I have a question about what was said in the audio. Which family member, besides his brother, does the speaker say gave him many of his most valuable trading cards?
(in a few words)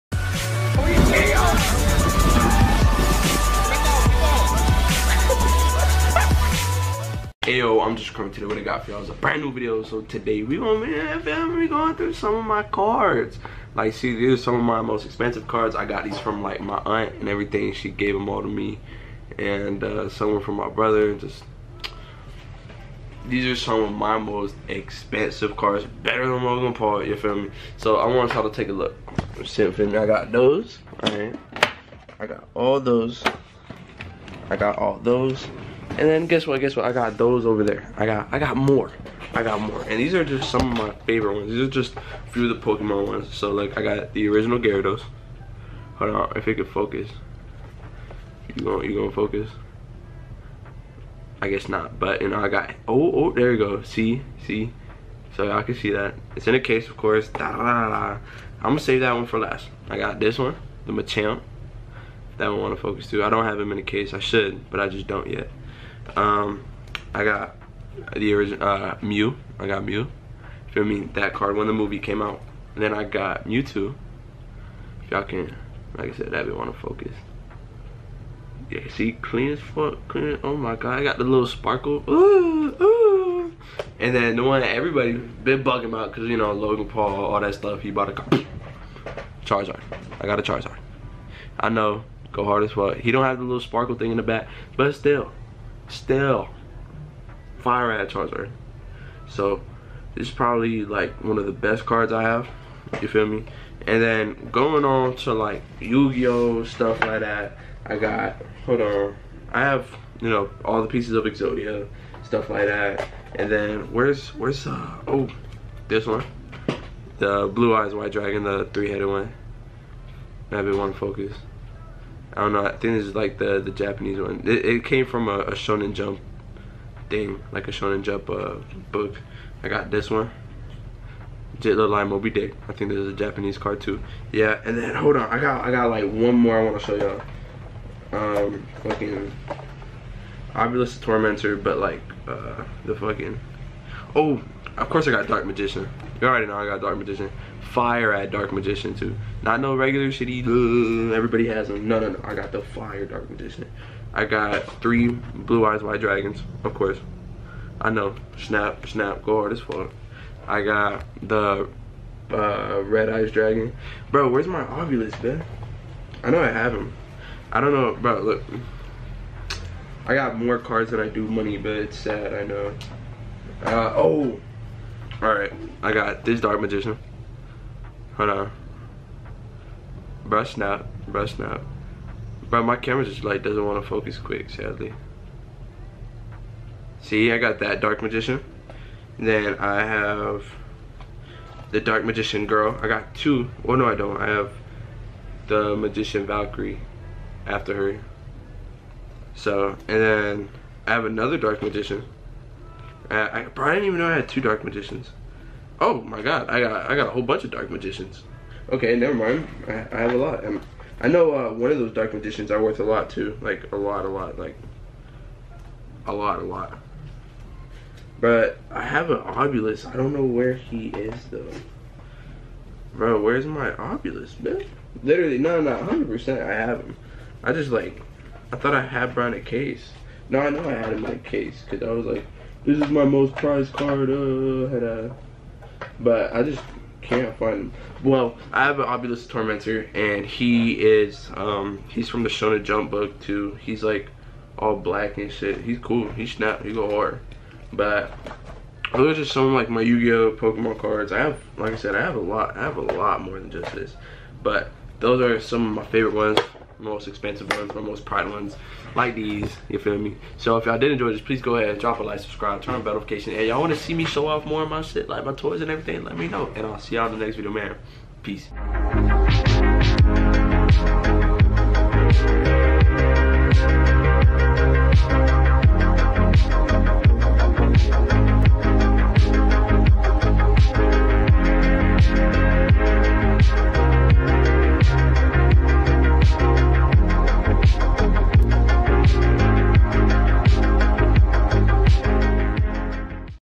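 Aunt.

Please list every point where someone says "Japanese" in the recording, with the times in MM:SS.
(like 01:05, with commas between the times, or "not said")
02:03, 02:13.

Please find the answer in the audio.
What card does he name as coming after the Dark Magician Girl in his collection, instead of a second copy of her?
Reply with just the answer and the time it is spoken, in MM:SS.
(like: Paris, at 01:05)
Magician Valkyrie, at 03:15.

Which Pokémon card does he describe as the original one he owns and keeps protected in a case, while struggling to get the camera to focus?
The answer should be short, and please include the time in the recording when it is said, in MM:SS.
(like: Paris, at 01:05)
Gyarados, at 00:44.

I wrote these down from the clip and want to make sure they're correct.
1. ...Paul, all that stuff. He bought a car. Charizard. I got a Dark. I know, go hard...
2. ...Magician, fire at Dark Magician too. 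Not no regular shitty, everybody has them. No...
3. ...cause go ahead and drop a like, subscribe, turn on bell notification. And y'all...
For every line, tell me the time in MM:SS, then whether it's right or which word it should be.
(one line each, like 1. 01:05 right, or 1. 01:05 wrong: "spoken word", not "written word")
1. 01:26 wrong: "Charizard", not "Dark"
2. 02:26 right
3. 04:21 wrong: "please", not "cause".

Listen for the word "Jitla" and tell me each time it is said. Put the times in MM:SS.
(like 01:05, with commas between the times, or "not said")
02:11.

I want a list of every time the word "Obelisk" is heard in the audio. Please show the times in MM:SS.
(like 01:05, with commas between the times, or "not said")
02:20, 02:44, 03:39, 03:43, 03:58.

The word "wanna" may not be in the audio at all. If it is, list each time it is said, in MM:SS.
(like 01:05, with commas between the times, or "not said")
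01:02, 04:23.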